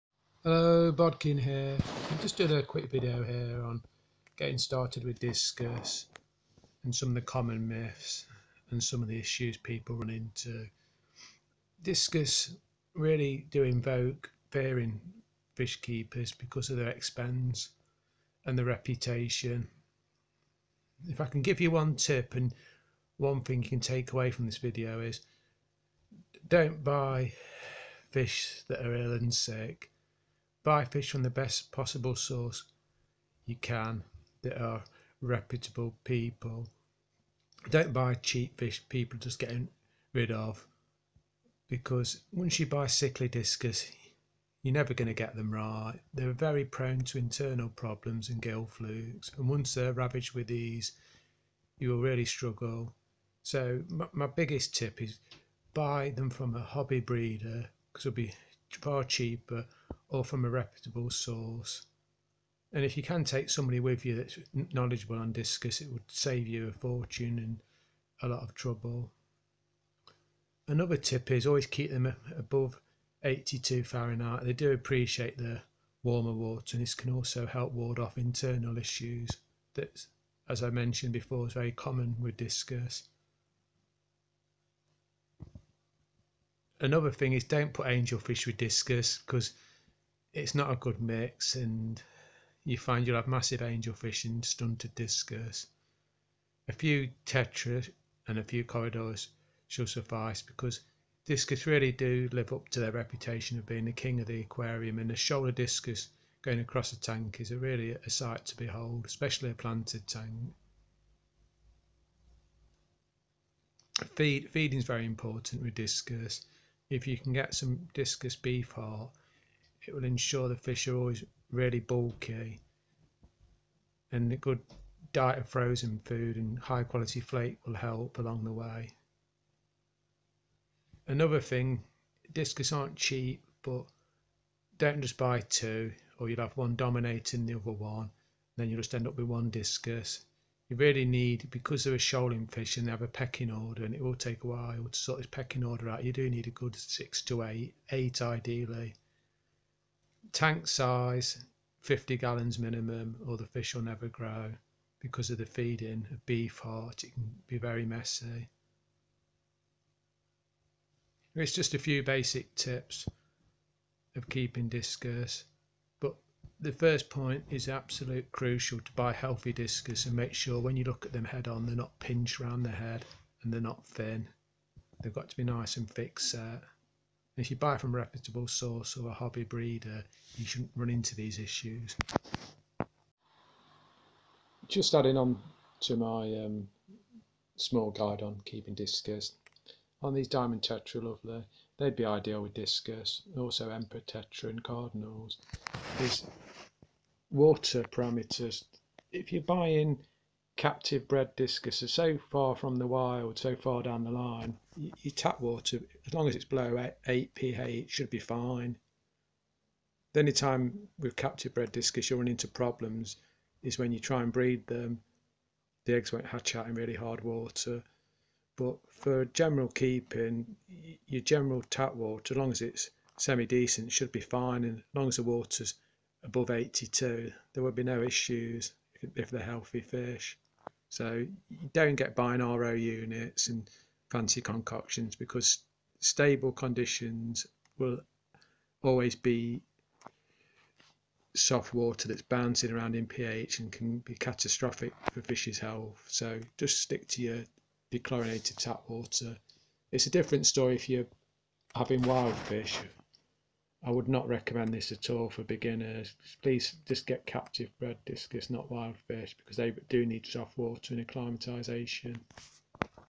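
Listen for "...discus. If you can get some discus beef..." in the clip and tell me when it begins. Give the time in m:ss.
1:55.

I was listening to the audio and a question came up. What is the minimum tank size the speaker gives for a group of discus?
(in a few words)
50 gallons.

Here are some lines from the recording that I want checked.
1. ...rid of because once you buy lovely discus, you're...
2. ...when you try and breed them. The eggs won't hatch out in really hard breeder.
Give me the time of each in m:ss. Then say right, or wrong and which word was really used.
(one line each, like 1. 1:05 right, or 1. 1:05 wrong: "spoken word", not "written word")
1. 0:40 wrong: "sickly", not "lovely"
2. 3:33 wrong: "water", not "breeder".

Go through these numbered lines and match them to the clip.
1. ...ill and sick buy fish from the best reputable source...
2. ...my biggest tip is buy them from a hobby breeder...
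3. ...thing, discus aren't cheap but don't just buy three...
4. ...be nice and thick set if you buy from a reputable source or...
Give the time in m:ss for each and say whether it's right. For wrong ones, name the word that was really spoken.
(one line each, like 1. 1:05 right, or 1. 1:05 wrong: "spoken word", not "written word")
1. 0:28 wrong: "possible", not "reputable"
2. 0:54 right
3. 2:11 wrong: "two", not "three"
4. 2:55 right.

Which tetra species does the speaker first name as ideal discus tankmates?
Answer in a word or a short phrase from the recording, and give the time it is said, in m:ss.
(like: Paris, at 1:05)
diamond tetra, at 3:10.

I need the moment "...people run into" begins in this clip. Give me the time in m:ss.
0:09.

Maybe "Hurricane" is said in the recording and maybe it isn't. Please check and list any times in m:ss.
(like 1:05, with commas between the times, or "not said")
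not said.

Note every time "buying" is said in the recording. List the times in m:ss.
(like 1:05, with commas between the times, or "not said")
3:19, 3:52.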